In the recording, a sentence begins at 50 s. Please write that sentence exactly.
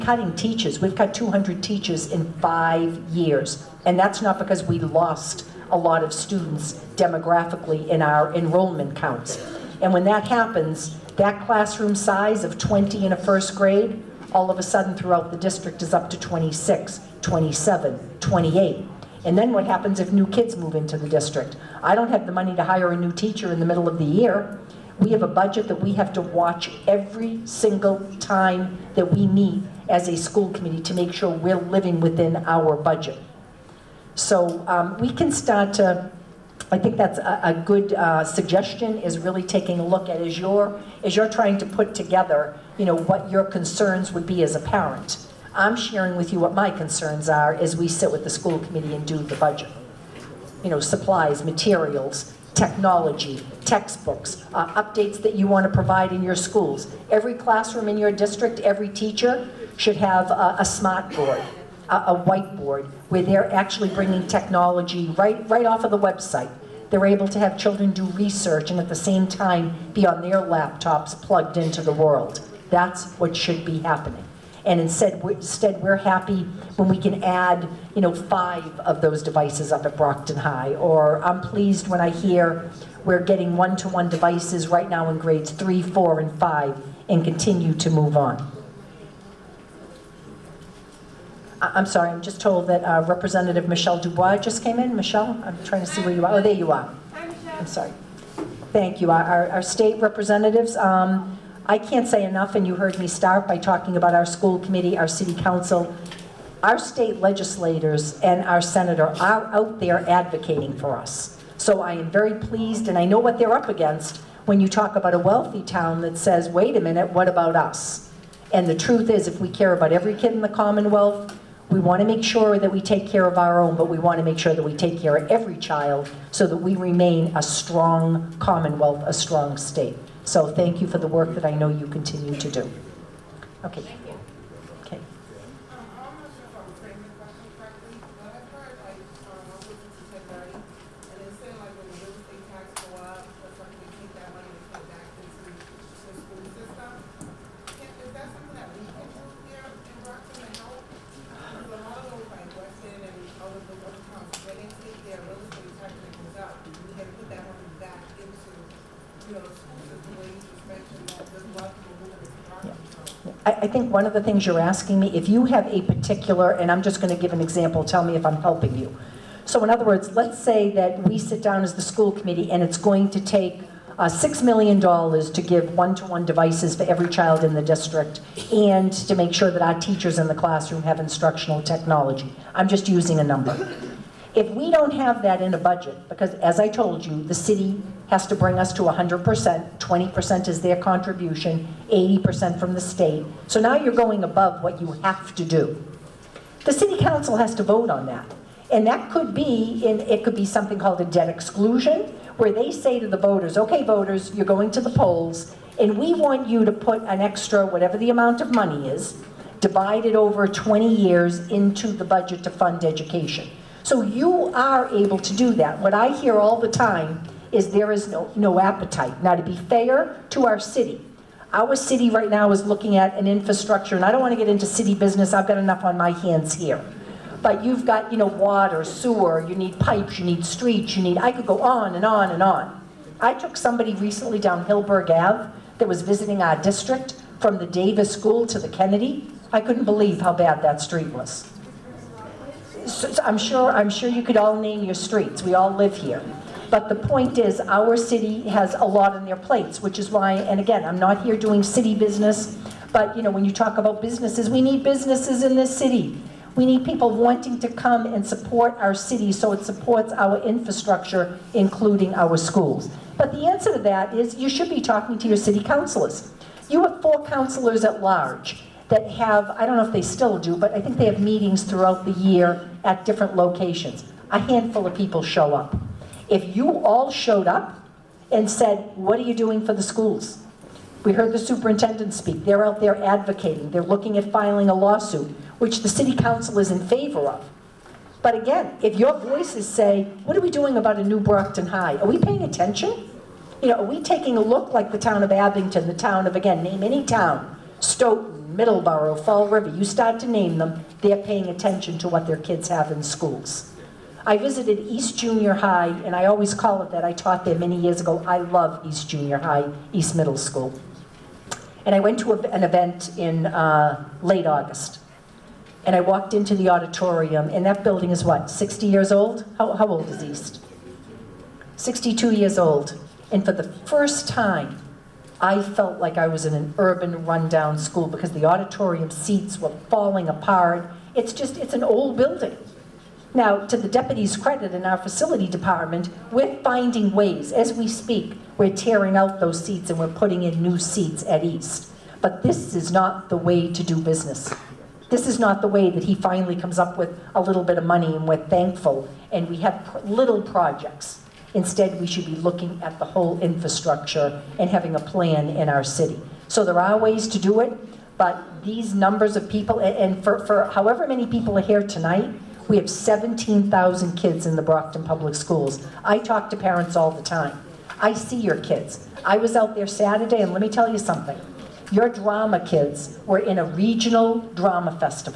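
You know, supplies, materials, technology, textbooks, uh, updates that you want to provide in your schools.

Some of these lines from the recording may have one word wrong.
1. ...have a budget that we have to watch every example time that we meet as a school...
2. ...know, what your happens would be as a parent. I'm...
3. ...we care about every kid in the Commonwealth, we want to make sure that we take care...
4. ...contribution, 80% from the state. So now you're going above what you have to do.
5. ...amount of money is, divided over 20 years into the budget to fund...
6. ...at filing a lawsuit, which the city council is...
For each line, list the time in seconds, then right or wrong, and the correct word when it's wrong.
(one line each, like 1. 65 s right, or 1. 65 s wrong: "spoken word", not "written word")
1. 25 s wrong: "single", not "example"
2. 42 s wrong: "concerns", not "happens"
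3. 119 s right
4. 190 s right
5. 208 s right
6. 284 s right.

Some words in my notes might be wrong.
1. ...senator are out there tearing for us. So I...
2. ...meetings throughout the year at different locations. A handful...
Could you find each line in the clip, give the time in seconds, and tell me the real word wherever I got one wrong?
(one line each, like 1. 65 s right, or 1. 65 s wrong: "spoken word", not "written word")
1. 108 s wrong: "advocating", not "tearing"
2. 271 s right.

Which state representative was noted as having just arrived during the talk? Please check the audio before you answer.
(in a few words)
Michelle Dubois.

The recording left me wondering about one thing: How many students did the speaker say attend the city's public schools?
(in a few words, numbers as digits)
17,000.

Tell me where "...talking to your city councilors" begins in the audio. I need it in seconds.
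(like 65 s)
264 s.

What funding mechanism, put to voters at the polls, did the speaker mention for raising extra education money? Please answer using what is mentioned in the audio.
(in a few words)
debt exclusion.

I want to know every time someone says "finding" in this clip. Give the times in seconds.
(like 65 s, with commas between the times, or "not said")
336 s.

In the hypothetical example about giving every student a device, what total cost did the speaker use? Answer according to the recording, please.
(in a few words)
$6 million.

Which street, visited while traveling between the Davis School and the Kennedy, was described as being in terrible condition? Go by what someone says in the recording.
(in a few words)
Hillberg Ave.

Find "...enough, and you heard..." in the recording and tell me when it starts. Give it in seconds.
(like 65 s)
102 s.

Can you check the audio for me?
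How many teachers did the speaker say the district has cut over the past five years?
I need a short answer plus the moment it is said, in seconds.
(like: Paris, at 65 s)
200, at 1 s.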